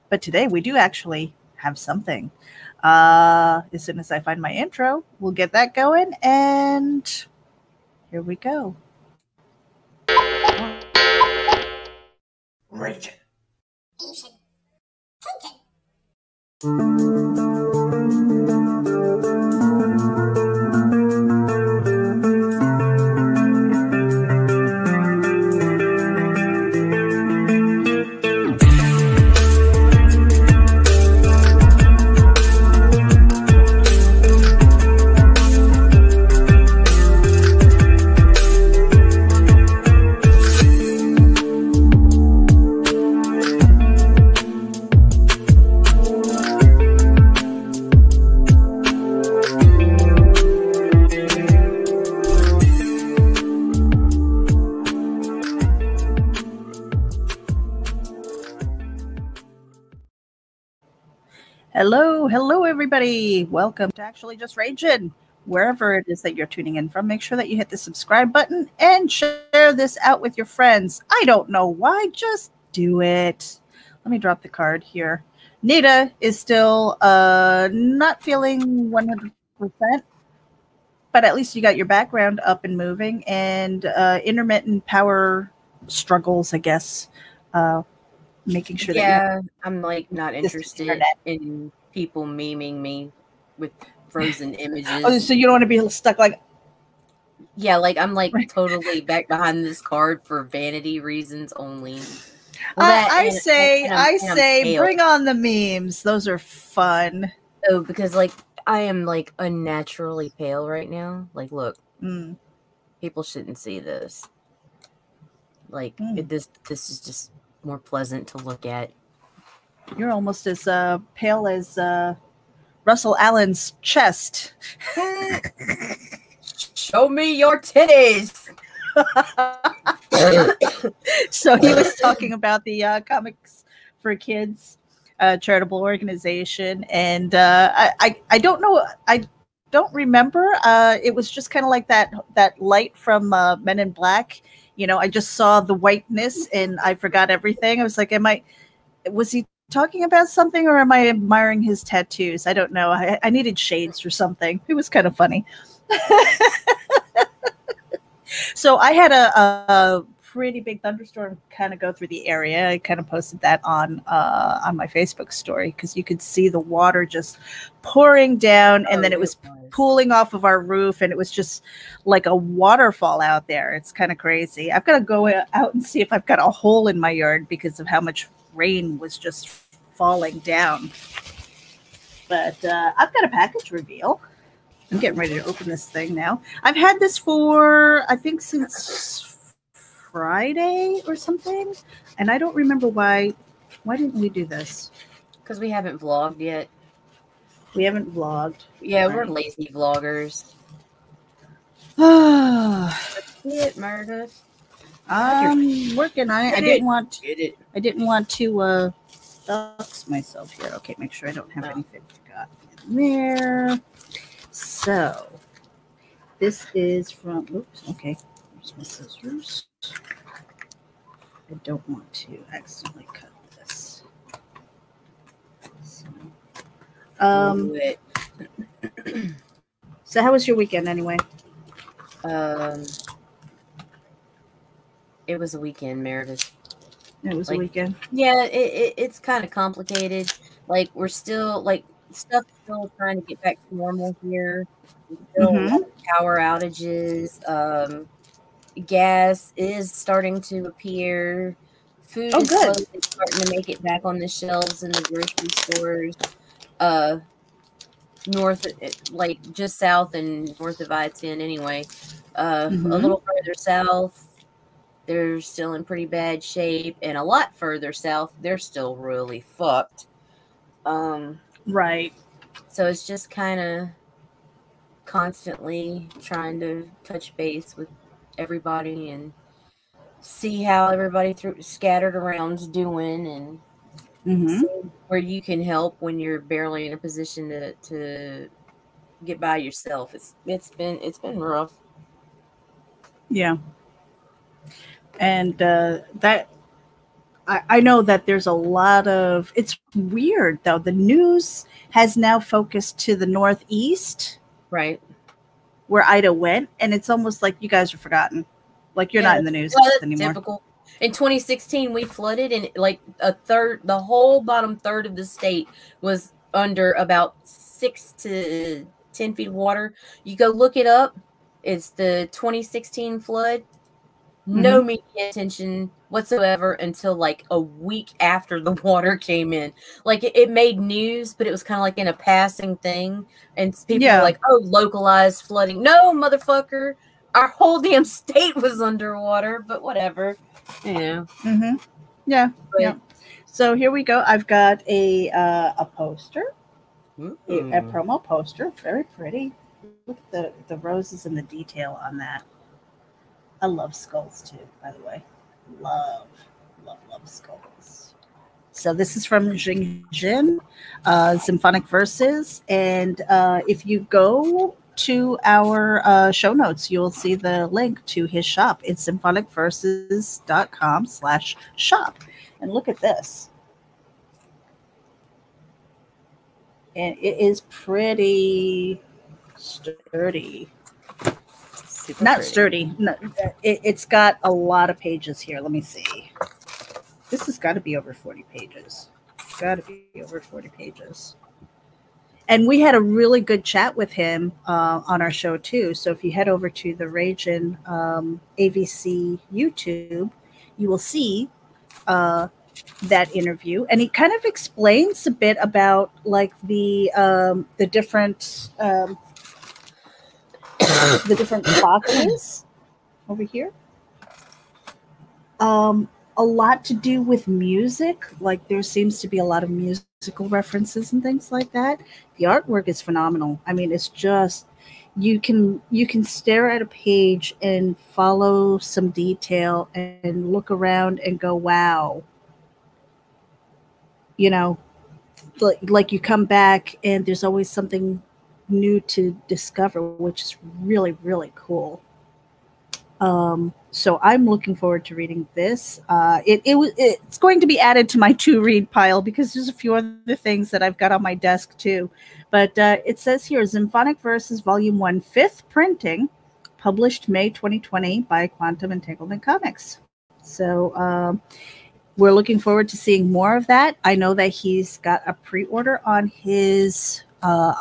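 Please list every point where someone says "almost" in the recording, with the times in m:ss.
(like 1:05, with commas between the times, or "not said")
2:00, 5:07.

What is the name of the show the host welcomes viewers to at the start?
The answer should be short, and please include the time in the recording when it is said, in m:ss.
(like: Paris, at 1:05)
Actually Just Ragin', at 1:04.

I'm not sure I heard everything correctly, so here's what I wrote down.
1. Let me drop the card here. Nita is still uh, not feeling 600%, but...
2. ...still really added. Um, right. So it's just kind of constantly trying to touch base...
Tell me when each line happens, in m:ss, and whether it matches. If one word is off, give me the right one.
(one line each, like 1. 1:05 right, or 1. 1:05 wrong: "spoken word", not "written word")
1. 1:14 wrong: "100", not "600"
2. 4:28 wrong: "fucked", not "added".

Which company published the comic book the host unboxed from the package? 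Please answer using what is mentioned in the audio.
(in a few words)
Quantum Entanglement Comics.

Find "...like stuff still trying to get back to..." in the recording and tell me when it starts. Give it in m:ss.
4:01.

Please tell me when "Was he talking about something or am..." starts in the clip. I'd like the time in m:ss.
2:29.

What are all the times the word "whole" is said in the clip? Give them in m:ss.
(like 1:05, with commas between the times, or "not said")
5:13, 5:37.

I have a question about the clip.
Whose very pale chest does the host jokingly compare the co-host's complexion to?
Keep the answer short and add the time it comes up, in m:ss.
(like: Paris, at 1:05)
Russell Allen, at 2:02.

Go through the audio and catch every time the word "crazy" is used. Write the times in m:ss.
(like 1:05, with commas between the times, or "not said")
2:54.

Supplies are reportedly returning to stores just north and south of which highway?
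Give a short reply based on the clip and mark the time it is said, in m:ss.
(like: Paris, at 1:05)
I-10, at 4:20.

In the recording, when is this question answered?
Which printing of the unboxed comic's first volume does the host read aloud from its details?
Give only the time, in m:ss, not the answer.
7:35.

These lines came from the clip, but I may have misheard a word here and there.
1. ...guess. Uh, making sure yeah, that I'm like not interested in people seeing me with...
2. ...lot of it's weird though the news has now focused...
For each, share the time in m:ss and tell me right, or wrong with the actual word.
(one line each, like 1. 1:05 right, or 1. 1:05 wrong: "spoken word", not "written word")
1. 1:26 wrong: "memeing", not "seeing"
2. 4:58 right.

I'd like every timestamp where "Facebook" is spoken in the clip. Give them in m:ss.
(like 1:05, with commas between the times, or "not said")
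2:44.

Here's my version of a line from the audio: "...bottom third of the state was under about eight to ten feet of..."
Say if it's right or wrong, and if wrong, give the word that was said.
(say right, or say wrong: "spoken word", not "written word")
wrong: "six", not "eight".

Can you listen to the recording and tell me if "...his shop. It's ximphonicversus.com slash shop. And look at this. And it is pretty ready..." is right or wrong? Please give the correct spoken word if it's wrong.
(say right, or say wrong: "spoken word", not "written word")
wrong: "sturdy", not "ready".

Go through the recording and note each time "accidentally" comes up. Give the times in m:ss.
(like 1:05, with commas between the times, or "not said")
3:42.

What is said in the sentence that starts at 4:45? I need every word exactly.
where you can help when you're barely in a position to, to get by yourself.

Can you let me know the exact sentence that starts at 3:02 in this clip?
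But uh, I've got a package reveal.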